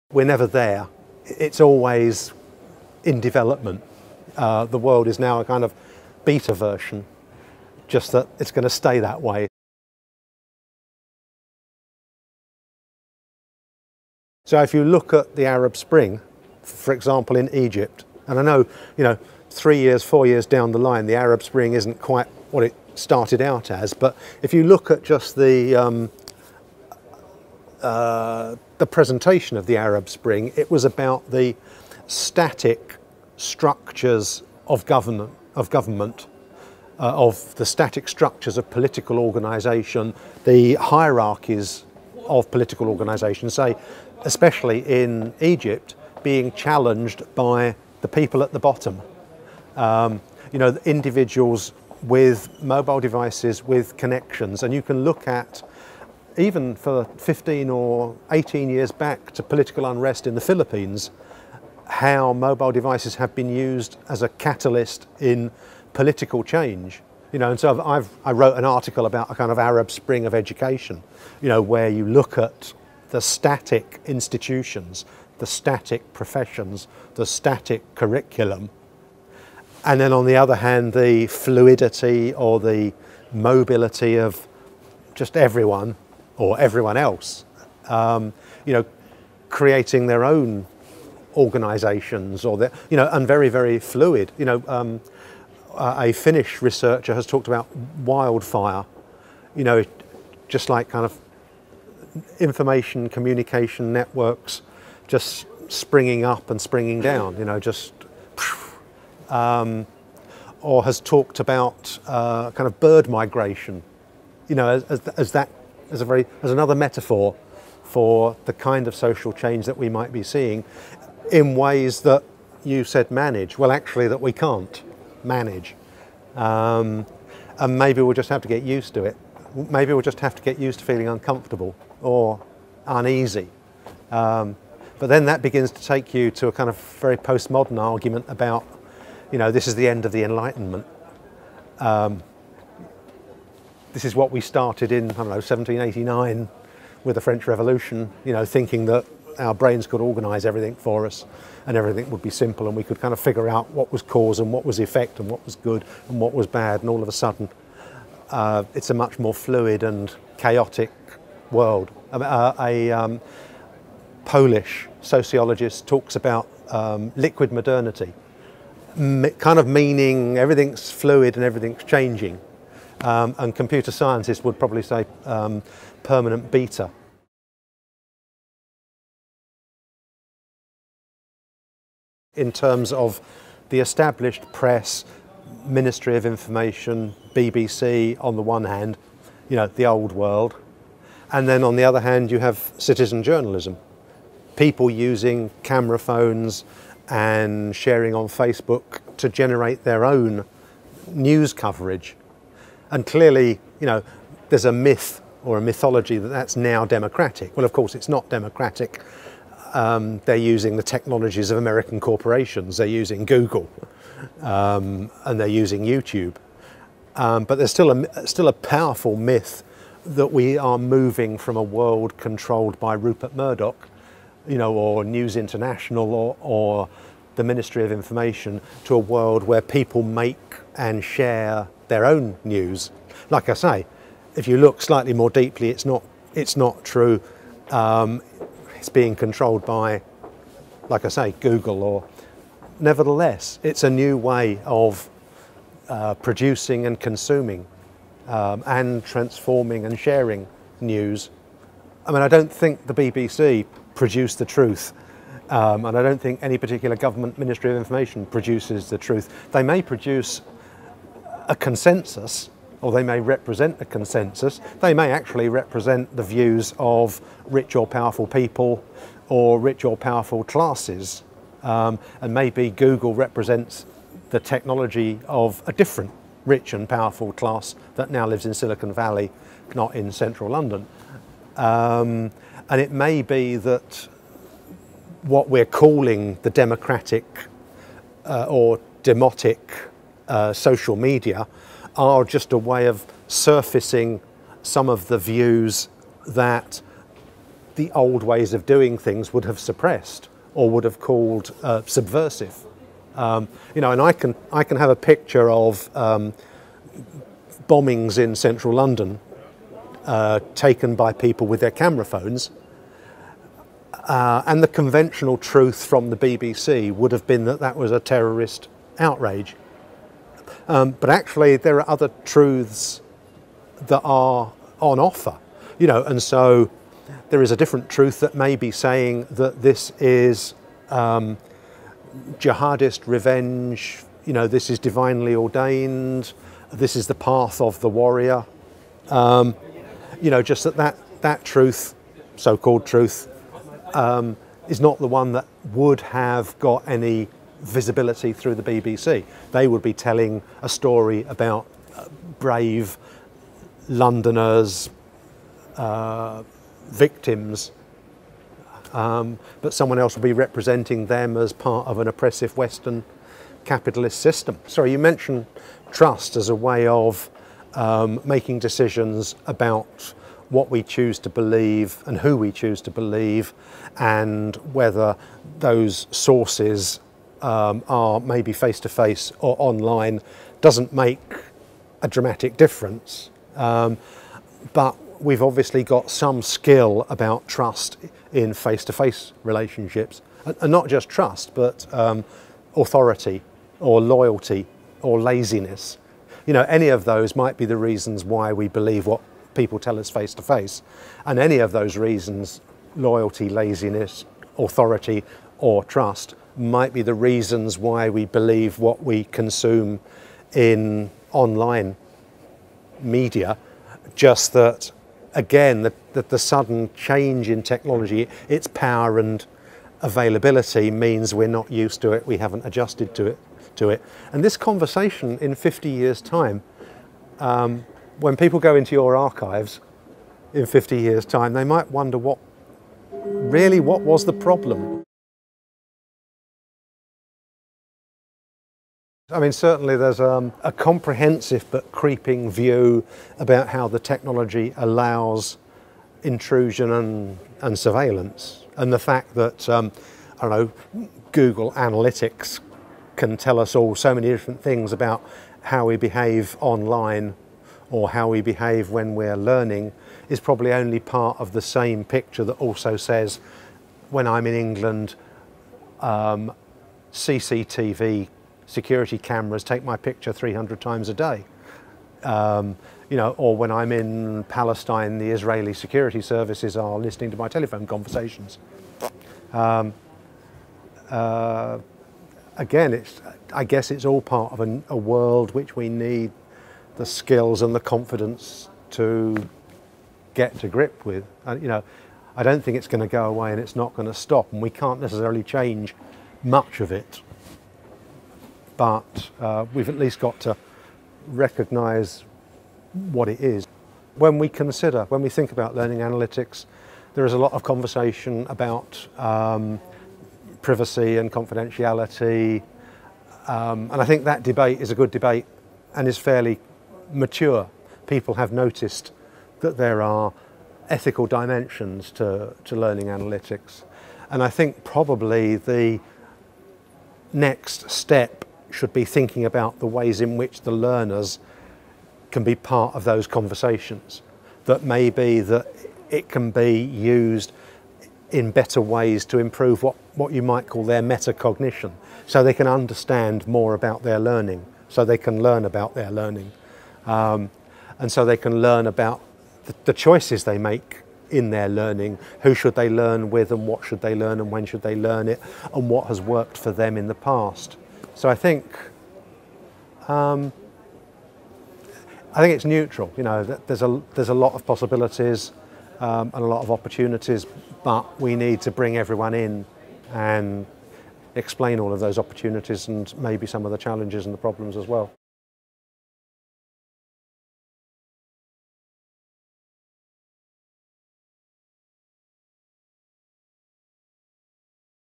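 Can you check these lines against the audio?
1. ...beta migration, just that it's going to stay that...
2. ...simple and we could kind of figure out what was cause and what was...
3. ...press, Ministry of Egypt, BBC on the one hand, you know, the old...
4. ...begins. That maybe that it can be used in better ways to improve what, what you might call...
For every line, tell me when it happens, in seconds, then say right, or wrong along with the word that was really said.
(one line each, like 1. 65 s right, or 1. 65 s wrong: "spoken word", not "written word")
1. 6 s wrong: "version", not "migration"
2. 152 s right
3. 184 s wrong: "Information", not "Egypt"
4. 533 s wrong: "conversations", not "begins".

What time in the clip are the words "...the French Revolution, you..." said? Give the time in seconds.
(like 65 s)
147 s.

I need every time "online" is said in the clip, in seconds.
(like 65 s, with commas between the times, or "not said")
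379 s, 411 s, 456 s.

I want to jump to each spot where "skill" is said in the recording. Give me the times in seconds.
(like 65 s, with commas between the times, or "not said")
386 s, 487 s.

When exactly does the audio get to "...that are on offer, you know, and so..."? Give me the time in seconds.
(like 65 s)
323 s.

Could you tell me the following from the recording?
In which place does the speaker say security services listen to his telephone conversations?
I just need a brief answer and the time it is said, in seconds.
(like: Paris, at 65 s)
Palestine, at 474 s.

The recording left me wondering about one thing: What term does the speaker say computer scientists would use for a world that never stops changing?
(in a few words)
Permanent beta.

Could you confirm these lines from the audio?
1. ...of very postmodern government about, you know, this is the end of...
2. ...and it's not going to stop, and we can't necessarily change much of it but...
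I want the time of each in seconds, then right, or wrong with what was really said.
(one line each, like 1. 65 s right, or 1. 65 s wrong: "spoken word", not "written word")
1. 136 s wrong: "argument", not "government"
2. 493 s right.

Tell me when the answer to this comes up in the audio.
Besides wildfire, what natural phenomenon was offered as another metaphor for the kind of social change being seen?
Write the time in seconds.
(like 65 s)
112 s.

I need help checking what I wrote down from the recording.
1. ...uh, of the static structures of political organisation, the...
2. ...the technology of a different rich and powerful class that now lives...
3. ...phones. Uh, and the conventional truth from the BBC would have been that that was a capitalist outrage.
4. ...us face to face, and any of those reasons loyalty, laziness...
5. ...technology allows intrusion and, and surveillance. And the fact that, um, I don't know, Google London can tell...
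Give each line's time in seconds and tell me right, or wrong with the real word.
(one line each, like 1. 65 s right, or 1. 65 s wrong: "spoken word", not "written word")
1. 36 s right
2. 274 s right
3. 312 s wrong: "terrorist", not "capitalist"
4. 399 s right
5. 443 s wrong: "Analytics", not "London".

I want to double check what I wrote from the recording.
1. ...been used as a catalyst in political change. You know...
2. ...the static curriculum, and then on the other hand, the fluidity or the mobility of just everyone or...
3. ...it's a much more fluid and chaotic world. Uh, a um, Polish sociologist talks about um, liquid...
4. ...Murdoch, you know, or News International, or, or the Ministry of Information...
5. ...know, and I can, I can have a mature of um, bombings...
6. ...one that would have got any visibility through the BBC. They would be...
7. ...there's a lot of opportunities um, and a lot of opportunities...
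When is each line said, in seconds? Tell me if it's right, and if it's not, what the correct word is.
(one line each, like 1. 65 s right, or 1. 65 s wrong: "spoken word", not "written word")
1. 63 s right
2. 77 s right
3. 158 s right
4. 223 s right
5. 303 s wrong: "picture", not "mature"
6. 345 s right
7. 564 s wrong: "possibilities", not "opportunities".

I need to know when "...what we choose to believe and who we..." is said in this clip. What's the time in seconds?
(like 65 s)
370 s.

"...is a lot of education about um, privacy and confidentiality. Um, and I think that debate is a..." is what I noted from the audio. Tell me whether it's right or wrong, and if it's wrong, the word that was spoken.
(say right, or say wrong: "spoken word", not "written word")
wrong: "conversation", not "education".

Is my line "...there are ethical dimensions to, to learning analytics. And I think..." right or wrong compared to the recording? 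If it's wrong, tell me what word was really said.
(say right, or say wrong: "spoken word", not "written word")
right.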